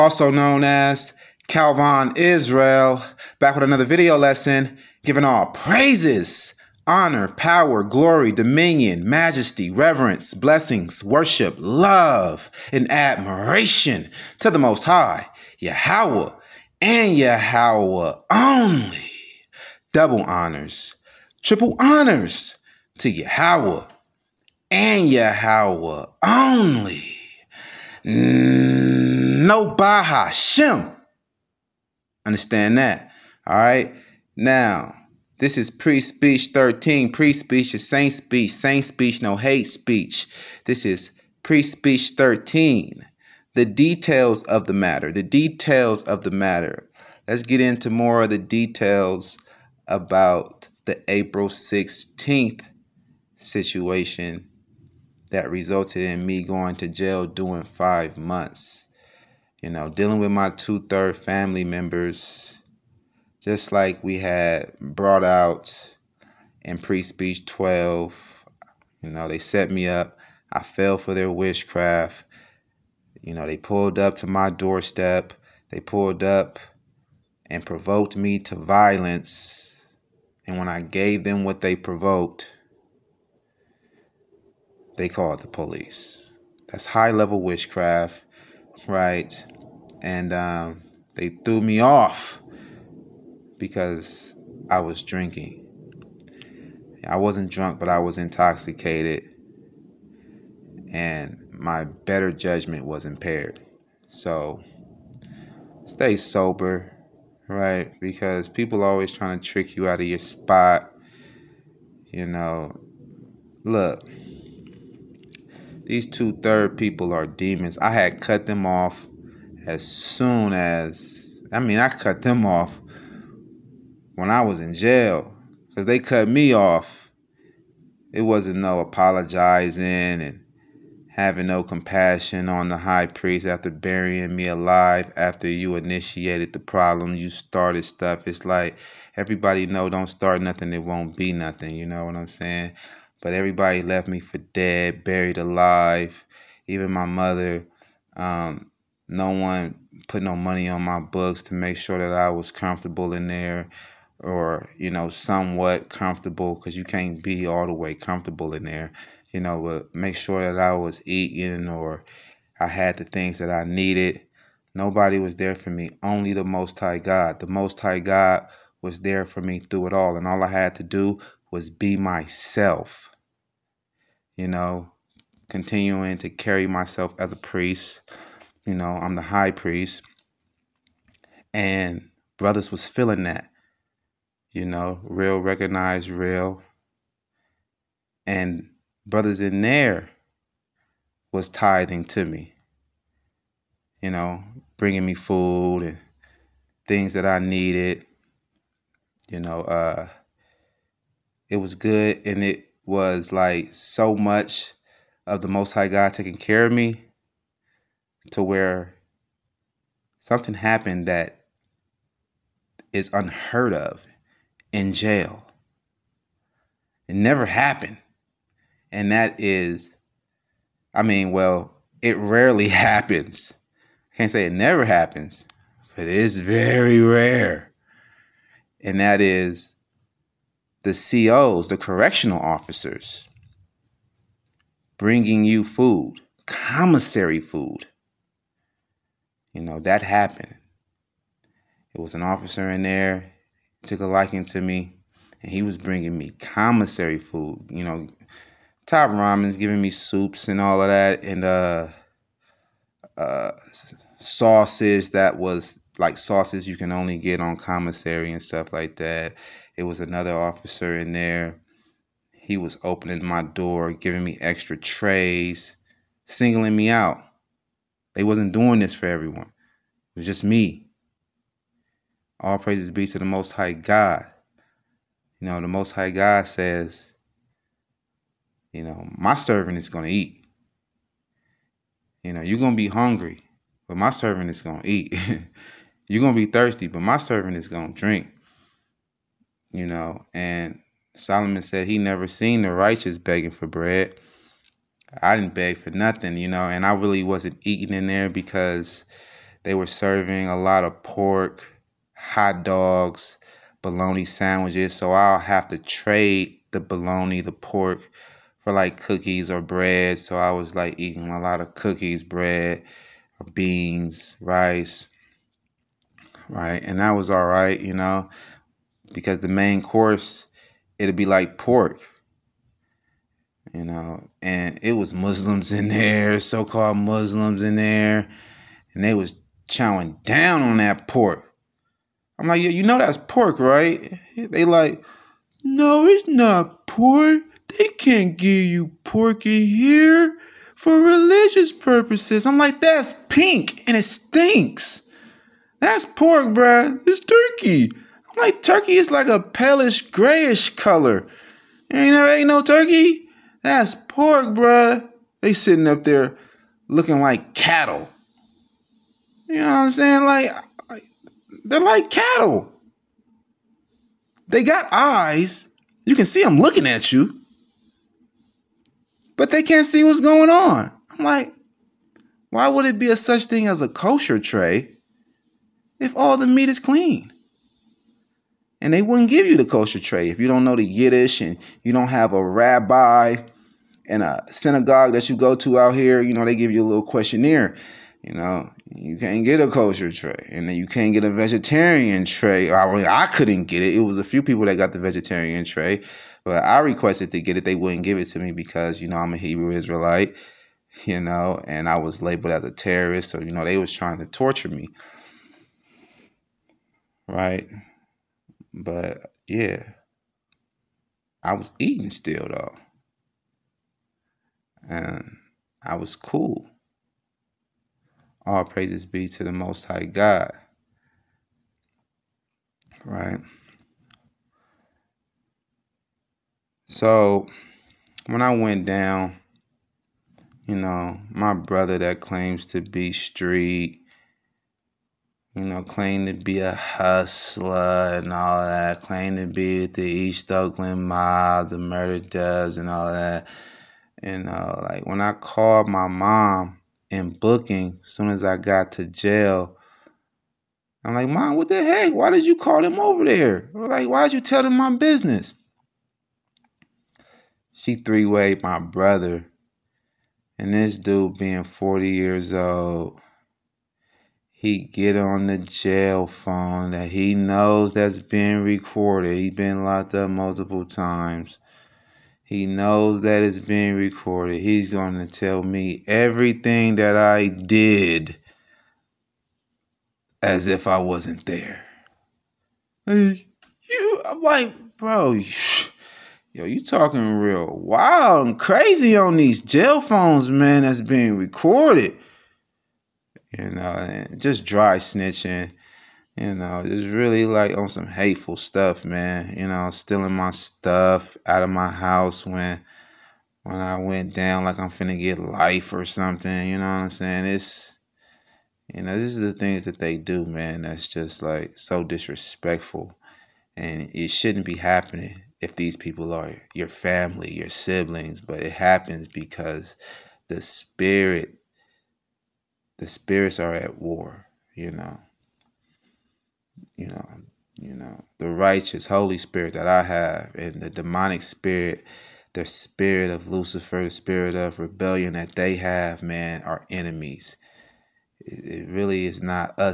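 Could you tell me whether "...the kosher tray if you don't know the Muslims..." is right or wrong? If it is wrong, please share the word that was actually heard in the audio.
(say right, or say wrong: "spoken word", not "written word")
wrong: "Yiddish", not "Muslims".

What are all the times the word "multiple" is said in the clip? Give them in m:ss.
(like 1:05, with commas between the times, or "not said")
7:50.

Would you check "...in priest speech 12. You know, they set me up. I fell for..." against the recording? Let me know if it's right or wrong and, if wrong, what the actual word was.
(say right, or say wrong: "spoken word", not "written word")
right.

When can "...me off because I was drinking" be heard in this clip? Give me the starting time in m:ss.
1:31.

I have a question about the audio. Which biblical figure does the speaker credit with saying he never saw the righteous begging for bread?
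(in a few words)
Solomon.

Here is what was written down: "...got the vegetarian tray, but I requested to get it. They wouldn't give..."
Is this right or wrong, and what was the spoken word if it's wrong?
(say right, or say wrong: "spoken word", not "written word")
right.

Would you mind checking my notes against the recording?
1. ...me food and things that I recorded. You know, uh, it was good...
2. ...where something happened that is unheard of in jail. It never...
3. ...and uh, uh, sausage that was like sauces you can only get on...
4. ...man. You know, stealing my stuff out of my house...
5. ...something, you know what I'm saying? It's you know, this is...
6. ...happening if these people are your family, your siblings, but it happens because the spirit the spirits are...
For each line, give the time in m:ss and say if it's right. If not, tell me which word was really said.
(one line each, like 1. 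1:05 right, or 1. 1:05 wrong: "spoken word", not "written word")
1. 3:15 wrong: "needed", not "recorded"
2. 3:28 right
3. 4:11 right
4. 8:19 right
5. 8:26 right
6. 8:34 right.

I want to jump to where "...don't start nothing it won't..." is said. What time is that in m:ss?
2:19.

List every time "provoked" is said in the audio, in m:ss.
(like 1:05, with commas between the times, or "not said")
1:17, 1:21.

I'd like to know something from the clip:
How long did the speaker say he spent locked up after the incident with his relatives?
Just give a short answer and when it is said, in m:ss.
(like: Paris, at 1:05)
5 months, at 0:57.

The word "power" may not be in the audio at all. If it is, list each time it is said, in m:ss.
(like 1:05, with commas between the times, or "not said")
0:07.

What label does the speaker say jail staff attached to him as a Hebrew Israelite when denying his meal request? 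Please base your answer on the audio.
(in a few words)
terrorist.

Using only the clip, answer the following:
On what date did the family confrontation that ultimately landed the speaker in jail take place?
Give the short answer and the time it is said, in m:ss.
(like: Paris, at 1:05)
April 16th, at 0:51.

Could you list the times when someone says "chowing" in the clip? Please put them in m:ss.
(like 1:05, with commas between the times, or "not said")
5:29.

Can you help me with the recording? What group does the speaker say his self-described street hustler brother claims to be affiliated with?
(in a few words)
East Oakland mob.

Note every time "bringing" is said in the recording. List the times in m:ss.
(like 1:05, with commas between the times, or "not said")
3:14, 3:54, 4:05.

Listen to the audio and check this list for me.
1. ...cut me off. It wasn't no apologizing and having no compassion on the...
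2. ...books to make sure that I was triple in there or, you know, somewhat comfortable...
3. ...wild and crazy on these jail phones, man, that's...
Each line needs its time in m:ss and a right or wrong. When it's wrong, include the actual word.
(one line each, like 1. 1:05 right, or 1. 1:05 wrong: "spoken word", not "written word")
1. 2:05 right
2. 2:30 wrong: "comfortable", not "triple"
3. 8:07 right.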